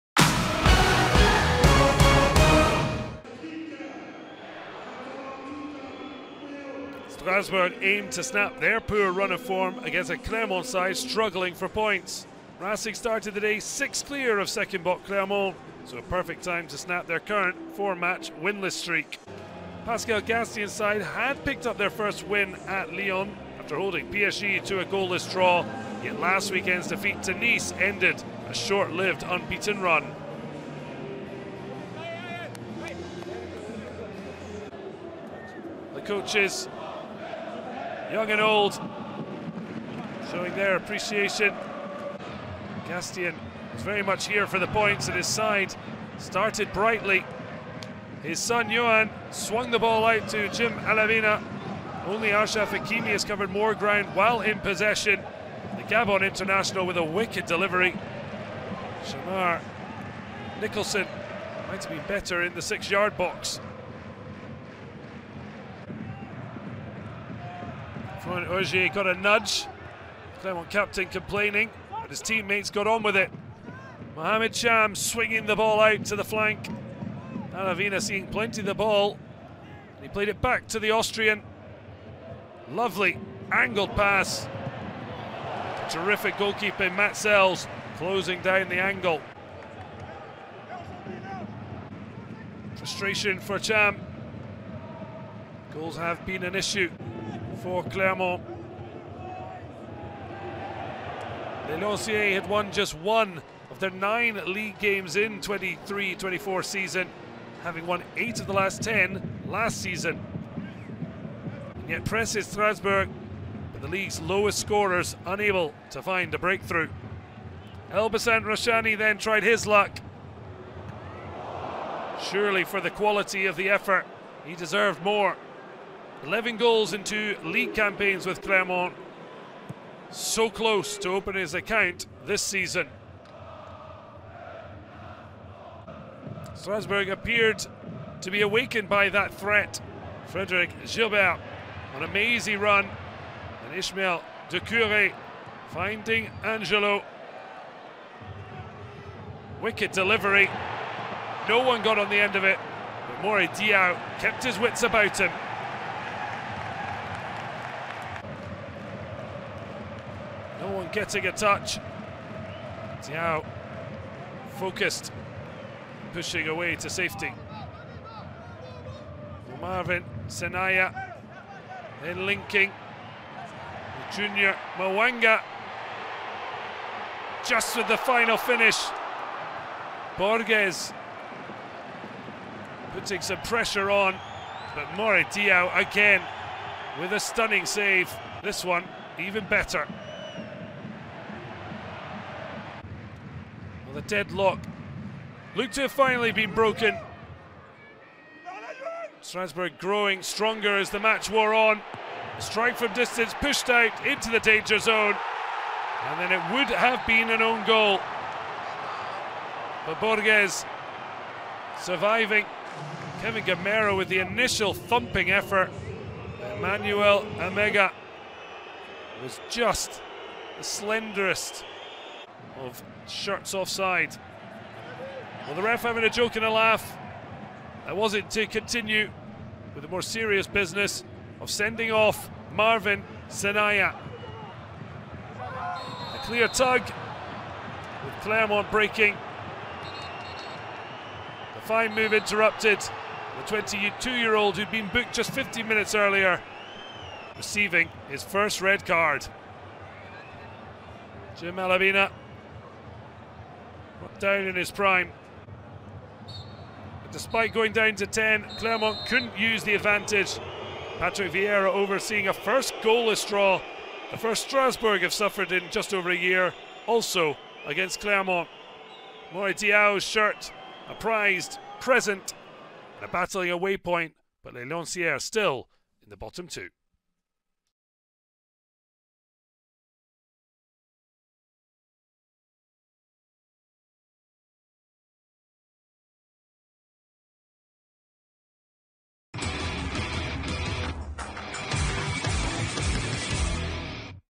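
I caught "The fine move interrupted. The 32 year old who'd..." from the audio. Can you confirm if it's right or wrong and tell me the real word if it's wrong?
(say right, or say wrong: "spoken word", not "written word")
wrong: "22", not "32".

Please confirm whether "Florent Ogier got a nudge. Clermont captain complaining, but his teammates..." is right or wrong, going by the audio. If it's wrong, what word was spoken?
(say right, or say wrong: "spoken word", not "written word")
right.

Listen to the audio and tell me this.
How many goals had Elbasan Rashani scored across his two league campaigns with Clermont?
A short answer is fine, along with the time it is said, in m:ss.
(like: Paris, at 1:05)
11, at 2:06.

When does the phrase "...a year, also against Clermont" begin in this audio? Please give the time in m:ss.
4:26.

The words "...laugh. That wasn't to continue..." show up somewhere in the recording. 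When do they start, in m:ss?
3:46.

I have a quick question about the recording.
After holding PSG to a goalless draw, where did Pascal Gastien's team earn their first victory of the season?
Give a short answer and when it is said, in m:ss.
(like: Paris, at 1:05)
Lyon, at 0:22.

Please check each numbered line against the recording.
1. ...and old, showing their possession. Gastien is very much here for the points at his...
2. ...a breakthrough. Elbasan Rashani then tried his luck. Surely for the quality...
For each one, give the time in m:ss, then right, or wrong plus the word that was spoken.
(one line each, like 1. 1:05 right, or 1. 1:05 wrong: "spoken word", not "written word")
1. 0:38 wrong: "appreciation", not "possession"
2. 1:56 right.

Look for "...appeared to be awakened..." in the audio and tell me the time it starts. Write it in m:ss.
2:17.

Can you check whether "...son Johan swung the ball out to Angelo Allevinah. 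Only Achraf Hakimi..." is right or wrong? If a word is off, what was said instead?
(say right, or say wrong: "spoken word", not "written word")
wrong: "Jim", not "Angelo".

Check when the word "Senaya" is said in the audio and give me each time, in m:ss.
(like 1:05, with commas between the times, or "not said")
2:50, 3:53.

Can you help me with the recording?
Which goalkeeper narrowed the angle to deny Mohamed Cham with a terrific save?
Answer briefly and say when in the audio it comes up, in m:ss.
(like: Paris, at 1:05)
Matz Sels, at 1:26.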